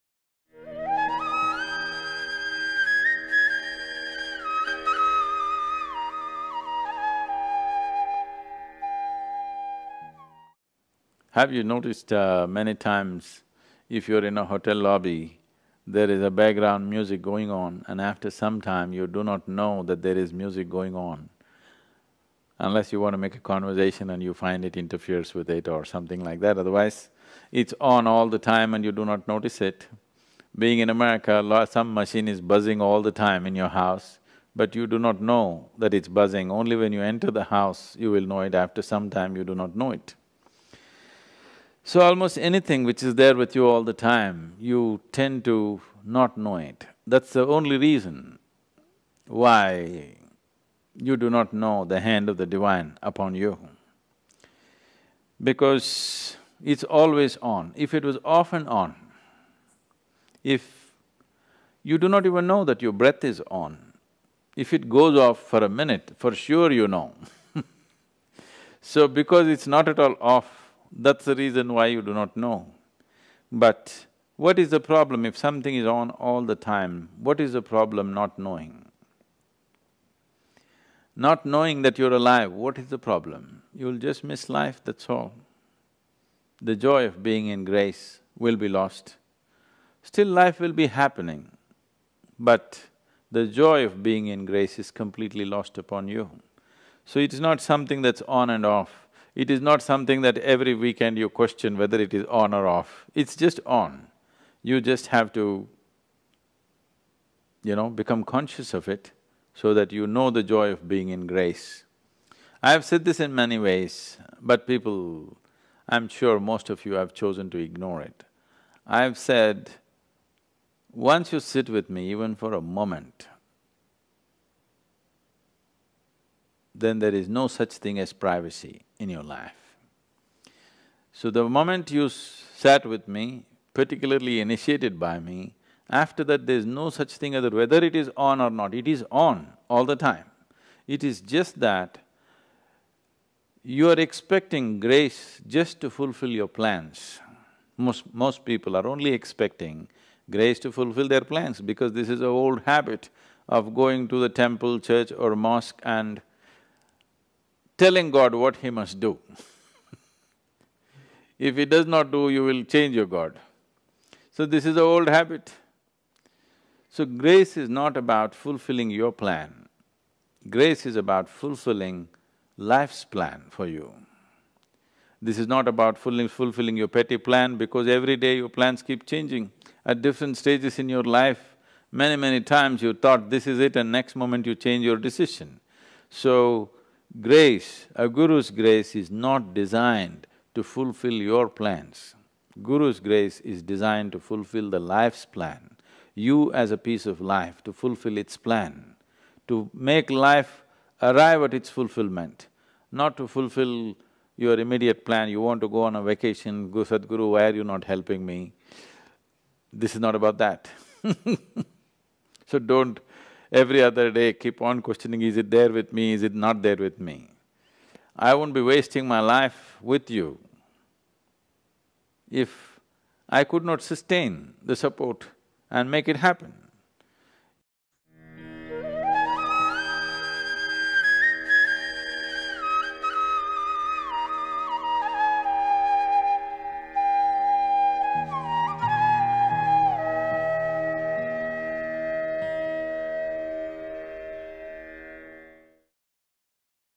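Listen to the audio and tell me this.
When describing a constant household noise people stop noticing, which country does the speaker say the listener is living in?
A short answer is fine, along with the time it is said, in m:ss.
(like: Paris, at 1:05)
America, at 0:30.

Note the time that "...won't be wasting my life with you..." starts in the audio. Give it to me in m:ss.
3:38.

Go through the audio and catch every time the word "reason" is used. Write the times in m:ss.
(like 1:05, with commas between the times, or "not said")
0:47, 1:11.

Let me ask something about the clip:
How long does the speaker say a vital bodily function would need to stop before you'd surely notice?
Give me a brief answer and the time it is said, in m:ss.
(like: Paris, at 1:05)
a minute, at 1:05.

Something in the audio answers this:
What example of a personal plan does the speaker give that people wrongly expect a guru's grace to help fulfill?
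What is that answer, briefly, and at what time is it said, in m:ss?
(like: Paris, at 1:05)
go on a vacation, at 3:25.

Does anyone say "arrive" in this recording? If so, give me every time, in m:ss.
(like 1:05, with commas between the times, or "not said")
3:21.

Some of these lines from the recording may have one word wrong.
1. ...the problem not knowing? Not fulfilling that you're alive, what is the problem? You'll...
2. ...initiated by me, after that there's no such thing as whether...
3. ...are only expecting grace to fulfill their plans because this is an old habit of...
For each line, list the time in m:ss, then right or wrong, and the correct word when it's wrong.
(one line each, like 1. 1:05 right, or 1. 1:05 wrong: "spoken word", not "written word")
1. 1:17 wrong: "knowing", not "fulfilling"
2. 2:14 right
3. 2:28 right.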